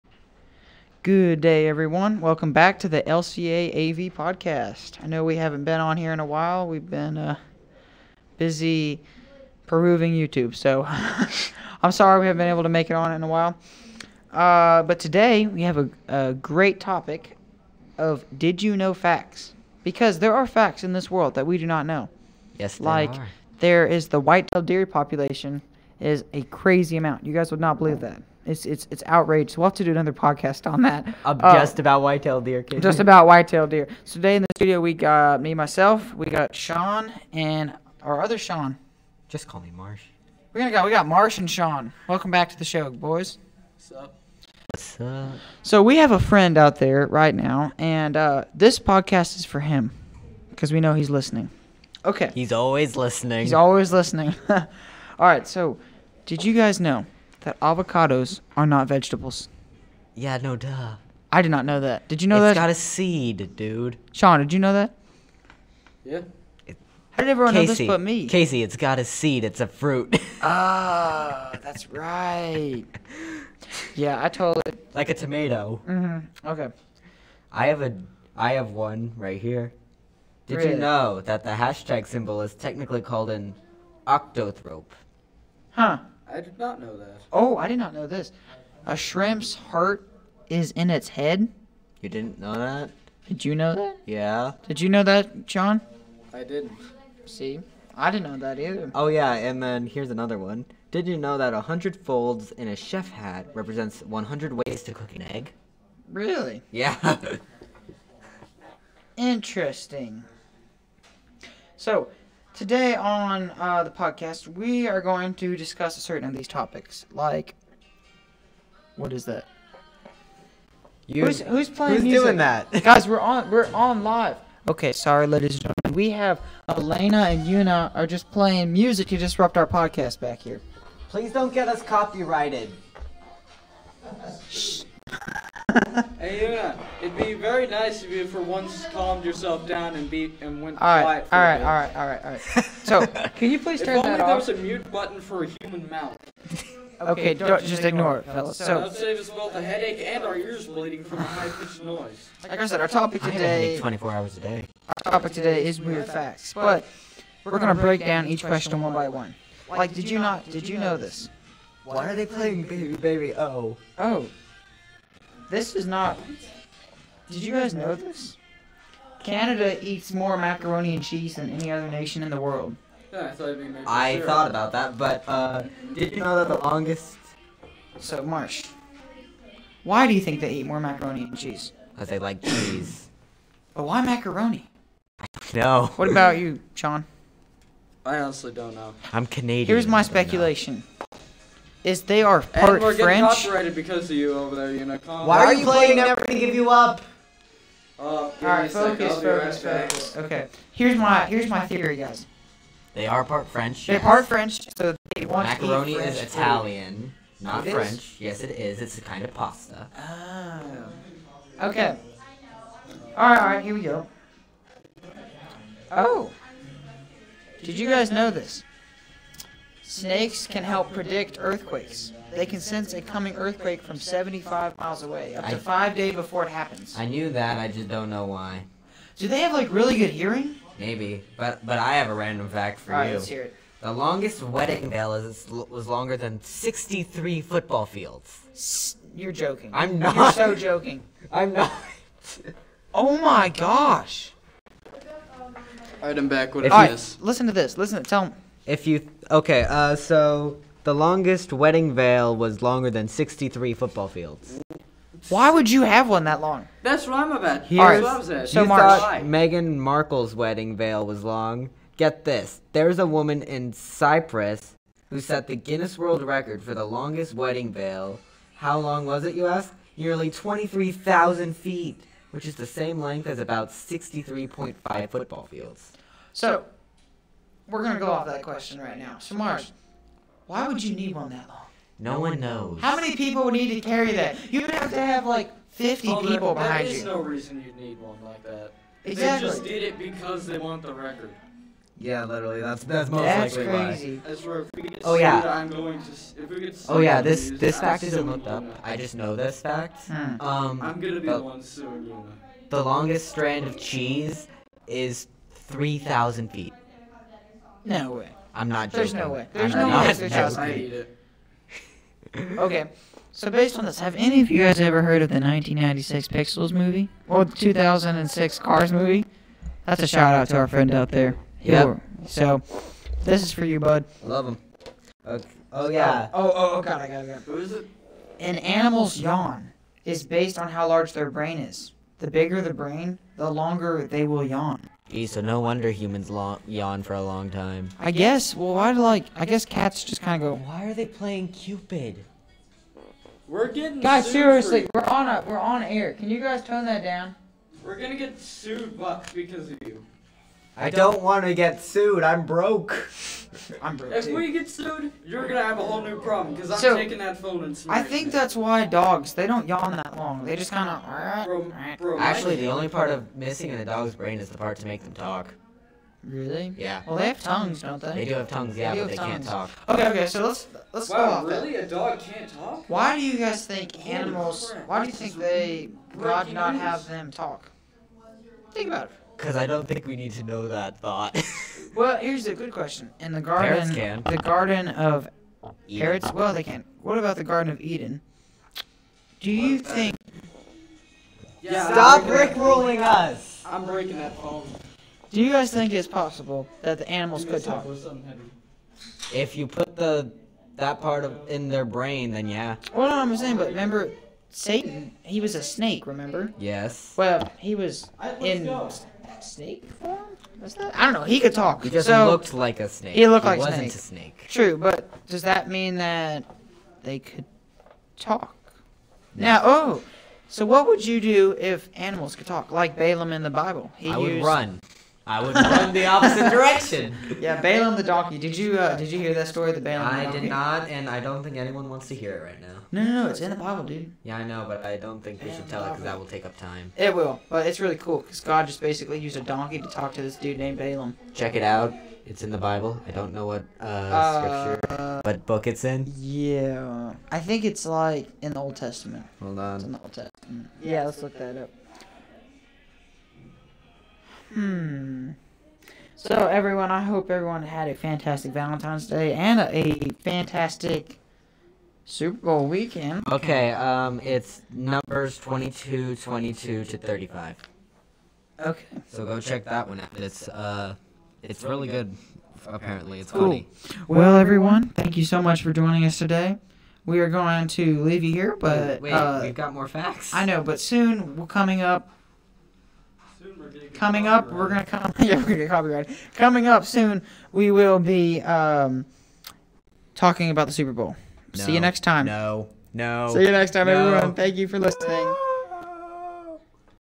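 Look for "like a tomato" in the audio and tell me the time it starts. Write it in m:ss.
1:14.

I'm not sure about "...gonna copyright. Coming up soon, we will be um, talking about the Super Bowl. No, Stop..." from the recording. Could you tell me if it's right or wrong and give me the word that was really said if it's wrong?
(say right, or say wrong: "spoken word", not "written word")
wrong: "See", not "Stop".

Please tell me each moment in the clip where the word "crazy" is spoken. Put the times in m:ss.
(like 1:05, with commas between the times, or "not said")
0:26, 4:54.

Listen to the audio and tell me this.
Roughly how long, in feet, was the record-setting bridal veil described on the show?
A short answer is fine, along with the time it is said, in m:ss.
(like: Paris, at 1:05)
23,000 feet, at 4:30.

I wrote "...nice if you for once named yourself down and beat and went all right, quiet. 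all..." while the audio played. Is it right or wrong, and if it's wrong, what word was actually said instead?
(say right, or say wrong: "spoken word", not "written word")
wrong: "calmed", not "named".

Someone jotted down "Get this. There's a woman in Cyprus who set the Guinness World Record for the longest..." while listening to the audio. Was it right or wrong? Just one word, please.
right.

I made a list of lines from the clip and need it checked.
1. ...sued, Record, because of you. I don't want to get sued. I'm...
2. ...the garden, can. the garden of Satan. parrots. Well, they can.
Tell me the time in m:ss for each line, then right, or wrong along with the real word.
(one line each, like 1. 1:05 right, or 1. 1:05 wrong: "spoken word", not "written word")
1. 5:48 wrong: "Buck", not "Record"
2. 6:23 wrong: "Eden", not "Satan".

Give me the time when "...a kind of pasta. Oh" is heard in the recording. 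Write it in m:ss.
3:28.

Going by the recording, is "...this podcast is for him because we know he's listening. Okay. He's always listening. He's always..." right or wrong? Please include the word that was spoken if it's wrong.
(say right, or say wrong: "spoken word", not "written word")
right.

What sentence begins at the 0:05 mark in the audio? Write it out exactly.
I know we haven't been on here in a while.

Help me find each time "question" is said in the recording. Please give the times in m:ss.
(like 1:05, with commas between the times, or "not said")
2:38, 4:38, 6:22.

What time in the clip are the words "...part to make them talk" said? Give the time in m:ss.
6:04.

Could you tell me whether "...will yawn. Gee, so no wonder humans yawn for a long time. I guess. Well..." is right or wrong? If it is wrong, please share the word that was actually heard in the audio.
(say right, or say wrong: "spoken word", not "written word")
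right.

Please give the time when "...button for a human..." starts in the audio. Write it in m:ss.
2:24.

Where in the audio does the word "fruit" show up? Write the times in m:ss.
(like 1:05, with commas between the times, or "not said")
1:09.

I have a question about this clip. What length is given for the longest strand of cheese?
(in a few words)
3,000 feet.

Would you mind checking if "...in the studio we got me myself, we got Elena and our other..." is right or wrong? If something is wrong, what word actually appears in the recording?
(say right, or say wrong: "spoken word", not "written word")
wrong: "Sean", not "Elena".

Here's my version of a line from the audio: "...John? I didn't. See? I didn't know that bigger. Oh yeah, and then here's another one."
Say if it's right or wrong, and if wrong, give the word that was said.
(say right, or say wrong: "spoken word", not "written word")
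wrong: "either", not "bigger".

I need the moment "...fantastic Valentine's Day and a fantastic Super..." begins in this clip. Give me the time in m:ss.
7:37.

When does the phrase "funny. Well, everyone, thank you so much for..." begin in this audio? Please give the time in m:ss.
7:53.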